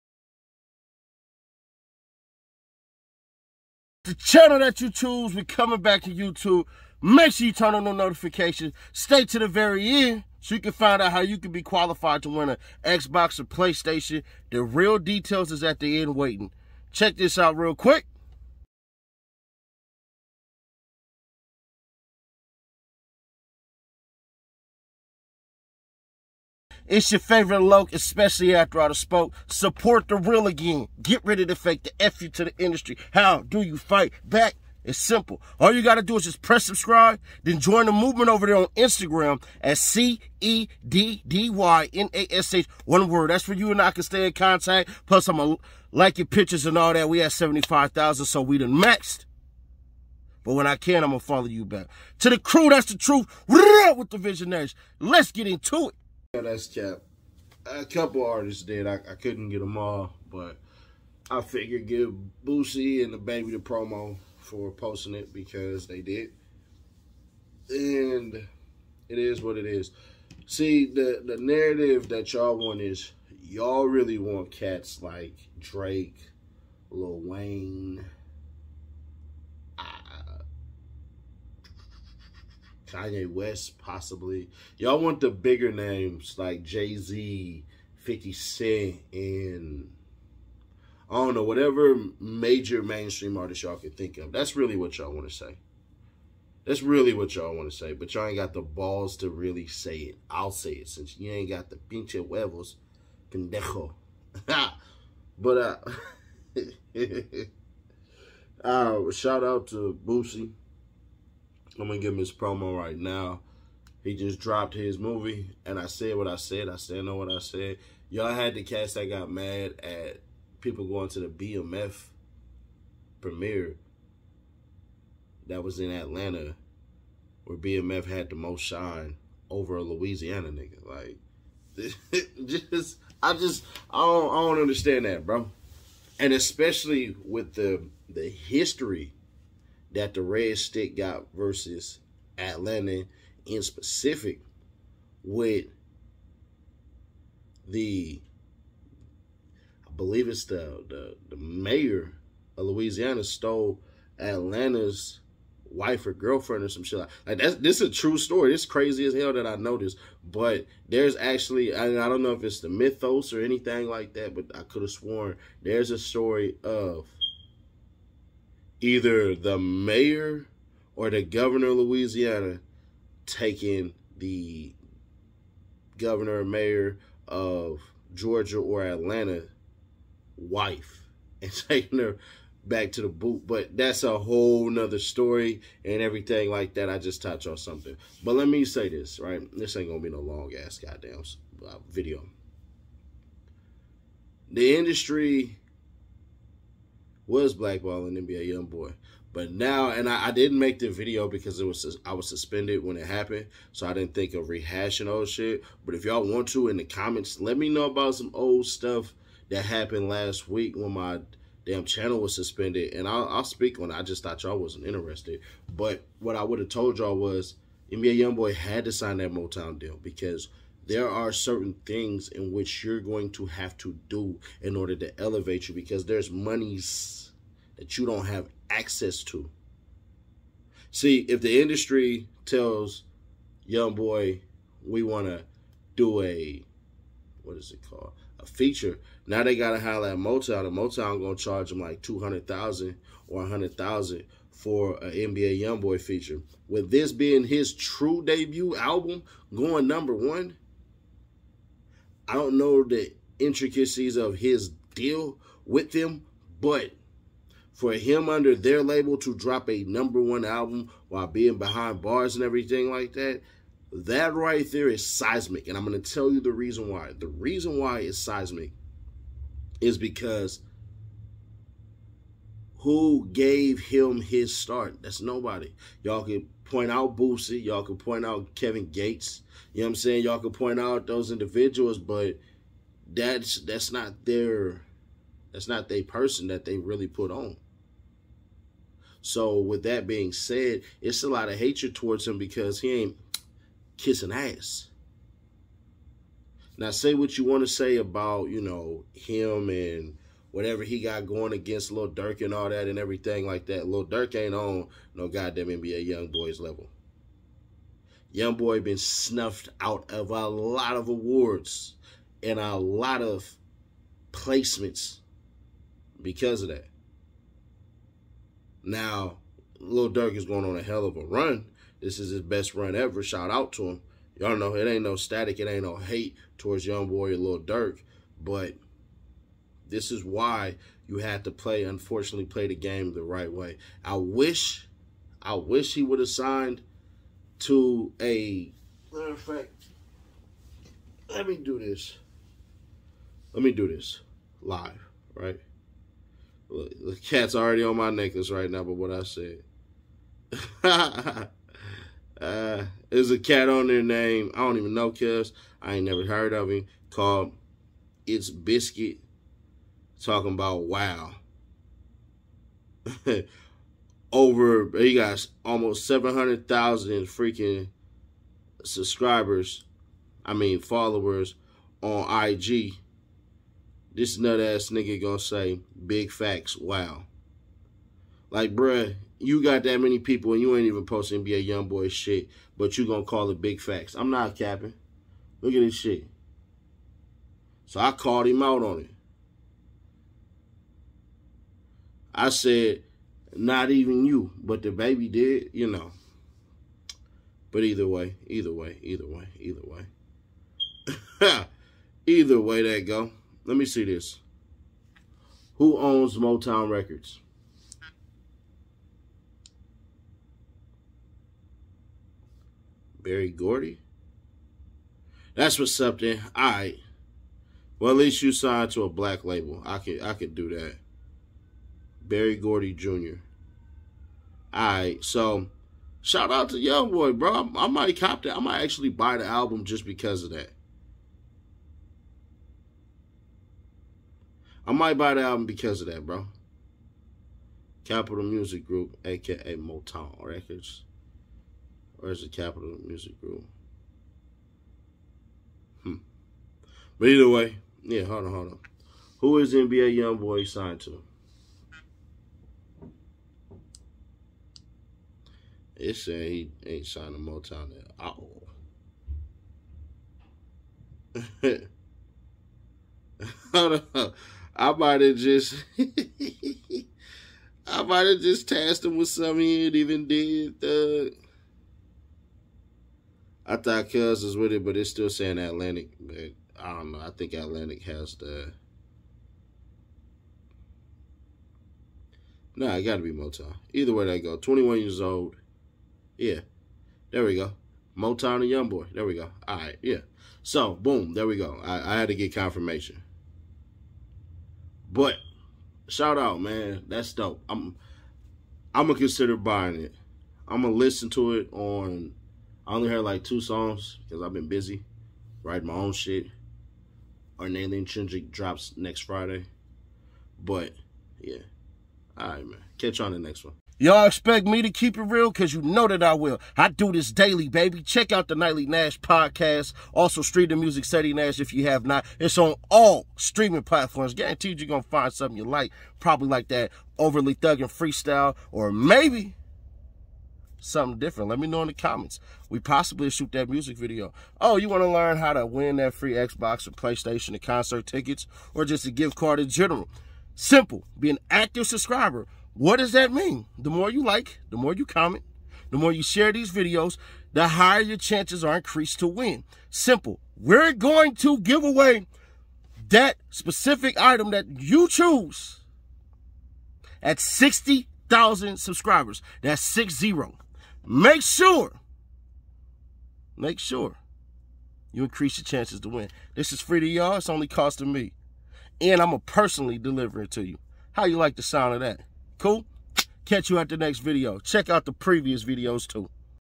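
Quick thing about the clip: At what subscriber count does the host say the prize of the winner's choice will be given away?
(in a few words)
60,000.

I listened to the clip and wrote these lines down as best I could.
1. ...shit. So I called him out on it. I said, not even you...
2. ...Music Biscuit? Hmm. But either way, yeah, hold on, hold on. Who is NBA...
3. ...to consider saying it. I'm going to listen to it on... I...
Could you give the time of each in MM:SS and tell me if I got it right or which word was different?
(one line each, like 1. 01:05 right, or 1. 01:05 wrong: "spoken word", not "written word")
1. 06:25 right
2. 07:23 wrong: "Group", not "Biscuit"
3. 08:19 wrong: "buying", not "saying".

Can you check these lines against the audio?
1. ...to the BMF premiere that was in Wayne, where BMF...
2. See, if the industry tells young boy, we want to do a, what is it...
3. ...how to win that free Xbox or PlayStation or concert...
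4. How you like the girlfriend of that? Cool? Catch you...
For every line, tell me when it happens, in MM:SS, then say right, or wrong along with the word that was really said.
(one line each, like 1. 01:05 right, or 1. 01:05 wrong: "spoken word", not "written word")
1. 02:01 wrong: "Atlanta", not "Wayne"
2. 03:50 right
3. 08:55 right
4. 09:31 wrong: "sound", not "girlfriend".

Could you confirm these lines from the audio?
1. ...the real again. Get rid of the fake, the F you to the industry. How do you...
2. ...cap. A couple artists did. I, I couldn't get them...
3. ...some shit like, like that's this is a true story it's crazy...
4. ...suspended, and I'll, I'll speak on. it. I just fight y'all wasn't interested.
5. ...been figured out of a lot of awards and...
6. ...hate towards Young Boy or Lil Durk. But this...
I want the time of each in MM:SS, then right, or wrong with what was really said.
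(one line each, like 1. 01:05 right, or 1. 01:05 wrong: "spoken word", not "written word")
1. 00:30 right
2. 00:56 right
3. 02:36 right
4. 03:32 wrong: "thought", not "fight"
5. 05:08 wrong: "snuffed", not "figured"
6. 05:25 right.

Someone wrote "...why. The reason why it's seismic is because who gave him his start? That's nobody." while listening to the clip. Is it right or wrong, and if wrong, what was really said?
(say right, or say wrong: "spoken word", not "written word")
right.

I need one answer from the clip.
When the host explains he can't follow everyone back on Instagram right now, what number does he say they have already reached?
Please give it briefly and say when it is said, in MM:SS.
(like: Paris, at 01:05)
75,000, at 00:47.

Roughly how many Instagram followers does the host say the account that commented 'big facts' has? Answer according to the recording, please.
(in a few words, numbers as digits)
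700,000.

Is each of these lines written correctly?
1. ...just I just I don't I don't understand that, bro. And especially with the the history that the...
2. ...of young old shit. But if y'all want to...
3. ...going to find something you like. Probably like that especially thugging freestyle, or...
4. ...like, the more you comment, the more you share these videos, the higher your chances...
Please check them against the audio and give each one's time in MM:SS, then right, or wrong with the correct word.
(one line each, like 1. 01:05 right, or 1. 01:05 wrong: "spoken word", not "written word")
1. 02:12 right
2. 03:24 wrong: "rehashing", not "young"
3. 08:44 wrong: "overly", not "especially"
4. 09:04 right.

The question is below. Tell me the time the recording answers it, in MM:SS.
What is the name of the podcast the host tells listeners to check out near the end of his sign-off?
08:38.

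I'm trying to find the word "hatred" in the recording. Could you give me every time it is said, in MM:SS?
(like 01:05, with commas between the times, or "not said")
04:51.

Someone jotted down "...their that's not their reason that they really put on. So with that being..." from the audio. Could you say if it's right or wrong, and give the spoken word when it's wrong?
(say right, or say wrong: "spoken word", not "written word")
wrong: "person", not "reason".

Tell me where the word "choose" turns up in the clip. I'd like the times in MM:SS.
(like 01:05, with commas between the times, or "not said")
00:04, 09:15.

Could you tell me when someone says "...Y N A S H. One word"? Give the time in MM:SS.
00:41.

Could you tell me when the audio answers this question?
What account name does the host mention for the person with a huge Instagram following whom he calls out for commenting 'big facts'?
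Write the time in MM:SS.
05:58.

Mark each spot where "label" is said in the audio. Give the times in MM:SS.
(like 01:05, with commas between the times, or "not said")
04:18, 06:59.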